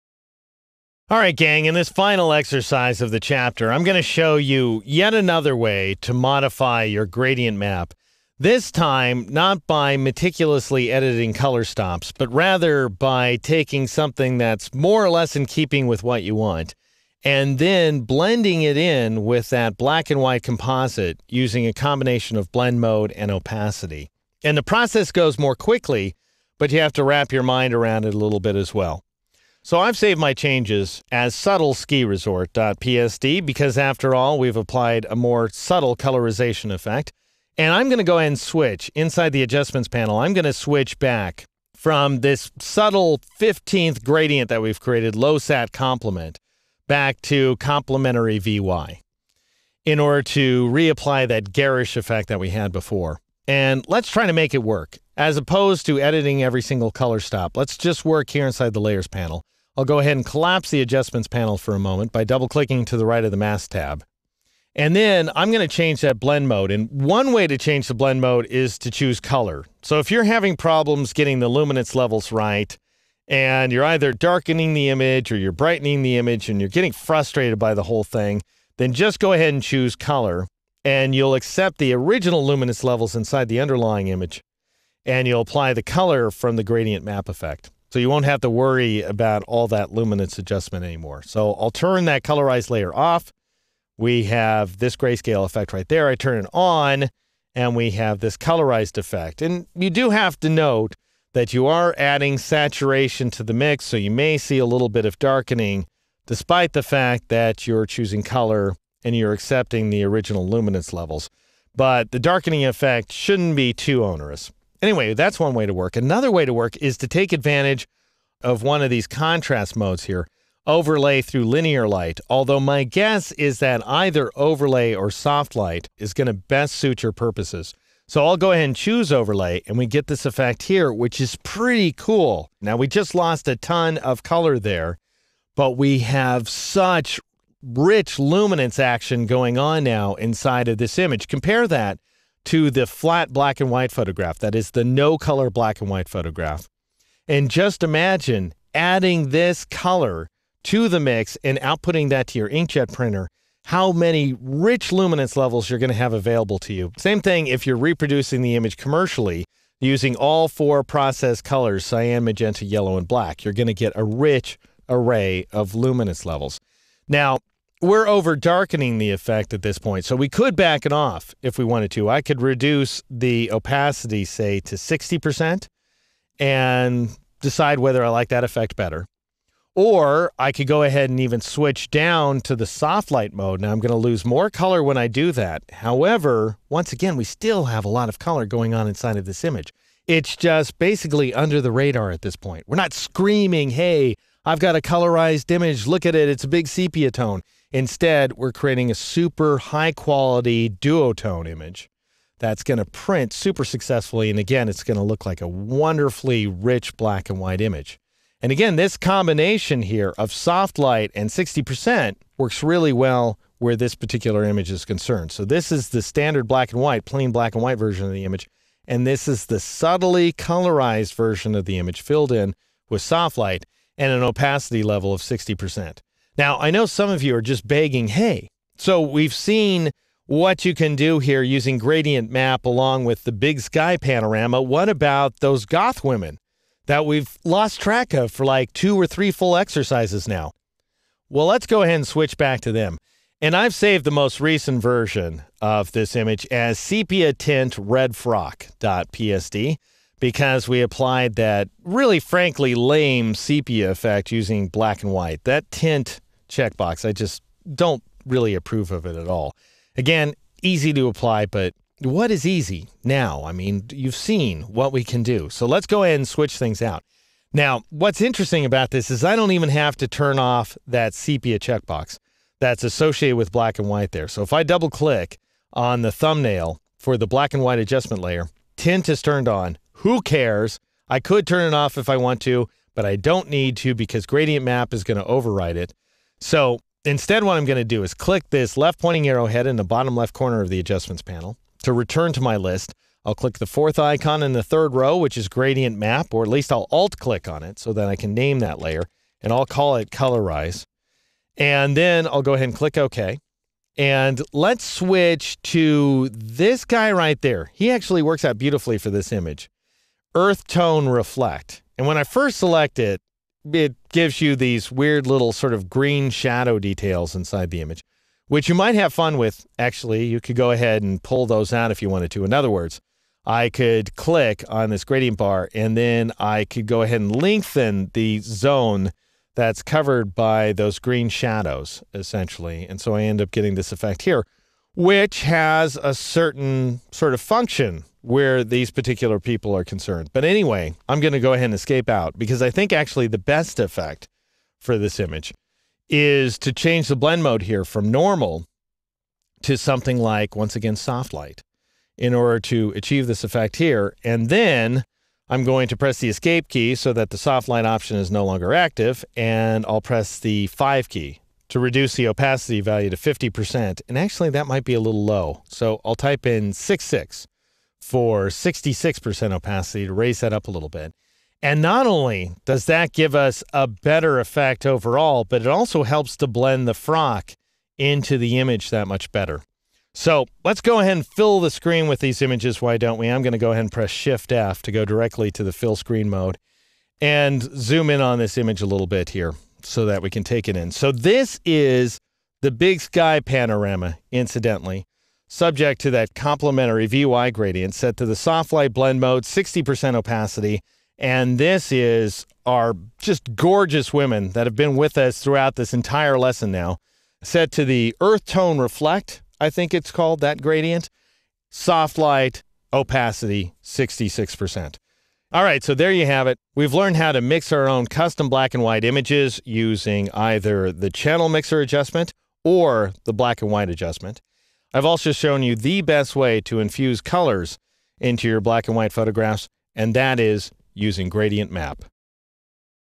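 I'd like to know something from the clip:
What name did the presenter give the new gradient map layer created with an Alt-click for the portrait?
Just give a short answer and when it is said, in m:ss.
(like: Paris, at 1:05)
colorize, at 5:00.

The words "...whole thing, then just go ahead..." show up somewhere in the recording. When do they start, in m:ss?
1:17.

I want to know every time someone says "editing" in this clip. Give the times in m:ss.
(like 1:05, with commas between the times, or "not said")
0:10, 0:55.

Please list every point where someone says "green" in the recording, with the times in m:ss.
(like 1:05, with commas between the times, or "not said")
5:15, 5:30.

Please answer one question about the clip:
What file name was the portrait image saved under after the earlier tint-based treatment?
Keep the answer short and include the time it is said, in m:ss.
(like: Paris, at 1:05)
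sepia tint redfrock.psd, at 4:06.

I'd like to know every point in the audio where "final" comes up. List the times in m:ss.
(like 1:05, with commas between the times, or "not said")
0:01.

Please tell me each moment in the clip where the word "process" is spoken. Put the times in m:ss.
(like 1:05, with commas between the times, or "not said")
0:24, 2:40.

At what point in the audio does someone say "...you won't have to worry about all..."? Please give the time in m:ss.
1:27.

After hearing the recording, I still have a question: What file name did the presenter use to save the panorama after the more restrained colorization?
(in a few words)
subtle sky.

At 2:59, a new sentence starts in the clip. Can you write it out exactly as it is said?
Or I could go ahead and even switch down to the soft light mode.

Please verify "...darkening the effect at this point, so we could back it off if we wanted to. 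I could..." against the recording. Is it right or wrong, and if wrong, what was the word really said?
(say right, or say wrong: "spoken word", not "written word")
right.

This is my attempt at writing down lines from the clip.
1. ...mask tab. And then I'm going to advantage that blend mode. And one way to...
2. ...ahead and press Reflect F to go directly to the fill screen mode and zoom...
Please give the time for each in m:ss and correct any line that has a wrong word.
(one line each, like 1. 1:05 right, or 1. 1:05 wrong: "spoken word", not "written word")
1. 1:03 wrong: "change", not "advantage"
2. 6:23 wrong: "Shift", not "Reflect".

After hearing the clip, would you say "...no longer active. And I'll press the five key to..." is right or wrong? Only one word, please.
right.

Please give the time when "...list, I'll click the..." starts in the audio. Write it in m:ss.
4:52.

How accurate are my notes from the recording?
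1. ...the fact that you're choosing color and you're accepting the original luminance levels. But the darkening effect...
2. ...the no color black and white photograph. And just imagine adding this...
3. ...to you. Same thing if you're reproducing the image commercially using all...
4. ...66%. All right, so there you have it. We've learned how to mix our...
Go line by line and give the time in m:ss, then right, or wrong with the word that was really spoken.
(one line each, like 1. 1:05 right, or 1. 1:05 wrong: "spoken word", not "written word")
1. 1:46 right
2. 2:24 right
3. 2:36 right
4. 6:53 right.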